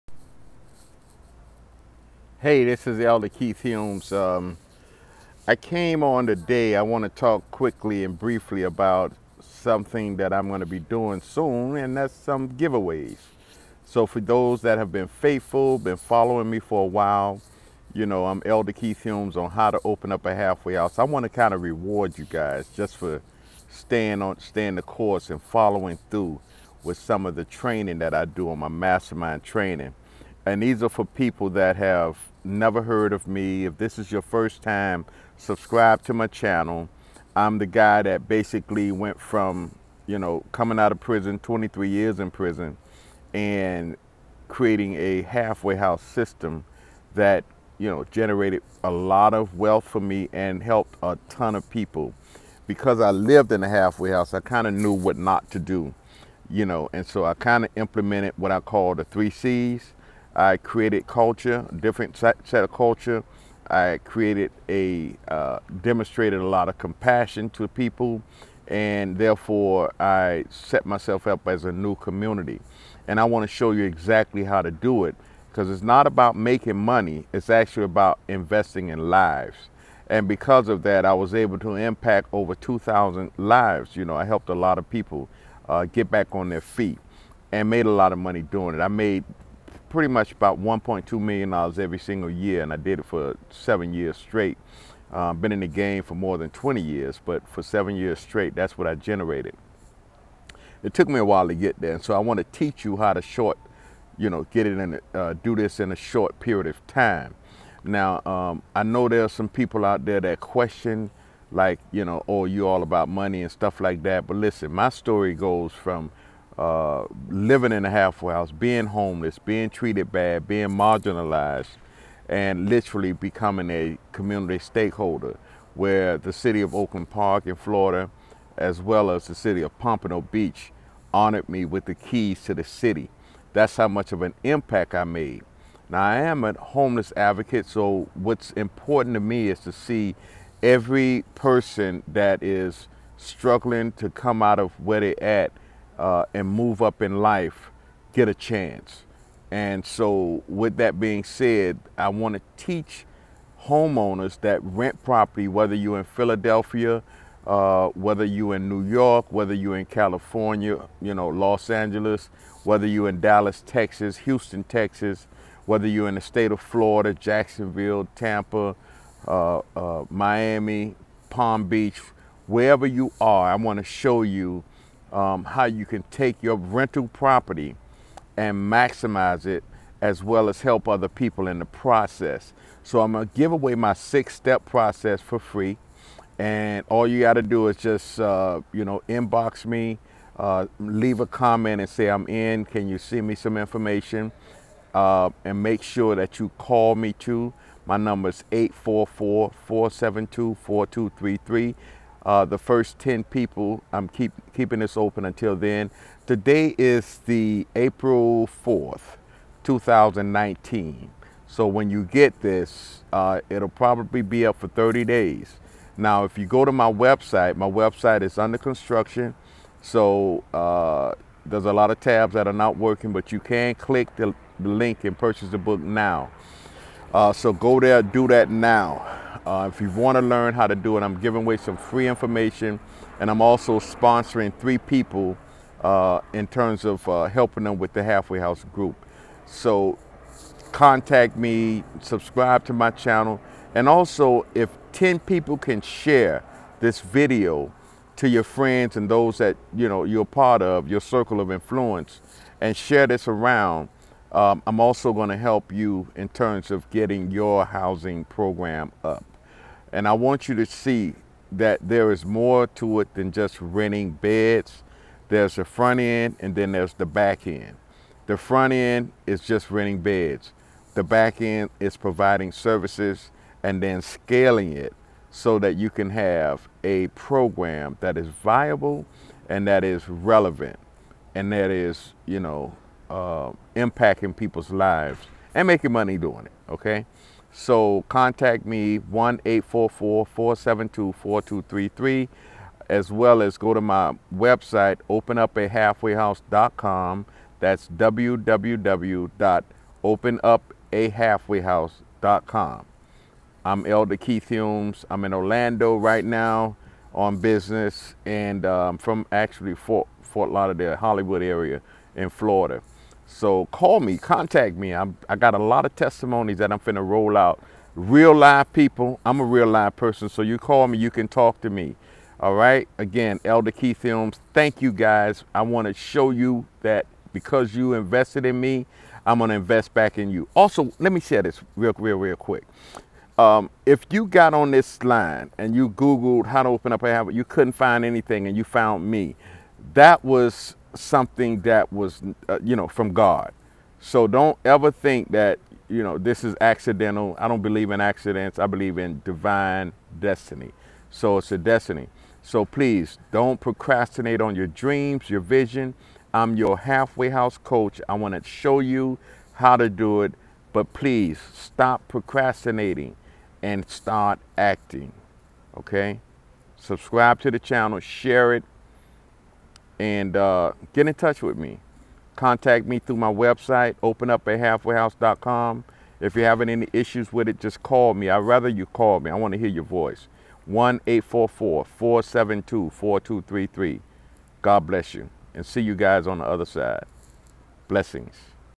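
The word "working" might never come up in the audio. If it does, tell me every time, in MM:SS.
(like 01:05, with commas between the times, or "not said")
03:42.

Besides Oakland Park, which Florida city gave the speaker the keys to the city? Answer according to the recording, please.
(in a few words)
Pompano Beach.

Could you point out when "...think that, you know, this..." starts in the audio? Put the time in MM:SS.
05:44.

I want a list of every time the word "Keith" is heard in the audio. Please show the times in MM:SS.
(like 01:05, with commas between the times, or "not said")
00:03, 00:18, 05:04, 05:23.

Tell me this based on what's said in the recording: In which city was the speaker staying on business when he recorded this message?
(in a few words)
Orlando.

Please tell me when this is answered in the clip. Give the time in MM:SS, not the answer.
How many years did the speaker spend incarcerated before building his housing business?
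00:41.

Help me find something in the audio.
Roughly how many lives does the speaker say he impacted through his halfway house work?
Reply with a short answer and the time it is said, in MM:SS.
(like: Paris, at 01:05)
2,000, at 01:22.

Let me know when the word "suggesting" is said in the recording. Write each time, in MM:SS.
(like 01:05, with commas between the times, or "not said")
not said.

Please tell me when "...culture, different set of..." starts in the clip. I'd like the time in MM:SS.
01:01.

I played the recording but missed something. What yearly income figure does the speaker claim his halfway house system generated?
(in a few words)
$1.2 million.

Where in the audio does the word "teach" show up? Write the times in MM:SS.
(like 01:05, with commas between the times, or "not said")
01:42, 02:32.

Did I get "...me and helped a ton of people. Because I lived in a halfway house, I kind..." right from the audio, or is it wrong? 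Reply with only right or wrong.
right.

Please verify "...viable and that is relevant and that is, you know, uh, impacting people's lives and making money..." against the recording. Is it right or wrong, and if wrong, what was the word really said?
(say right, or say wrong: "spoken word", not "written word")
right.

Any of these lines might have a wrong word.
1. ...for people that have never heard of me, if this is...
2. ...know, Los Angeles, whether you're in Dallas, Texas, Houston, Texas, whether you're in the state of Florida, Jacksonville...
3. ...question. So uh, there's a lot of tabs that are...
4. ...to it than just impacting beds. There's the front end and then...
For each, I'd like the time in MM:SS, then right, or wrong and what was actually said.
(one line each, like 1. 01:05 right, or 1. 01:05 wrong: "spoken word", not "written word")
1. 00:30 right
2. 02:41 right
3. 03:38 wrong: "construction", not "question"
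4. 04:22 wrong: "renting", not "impacting".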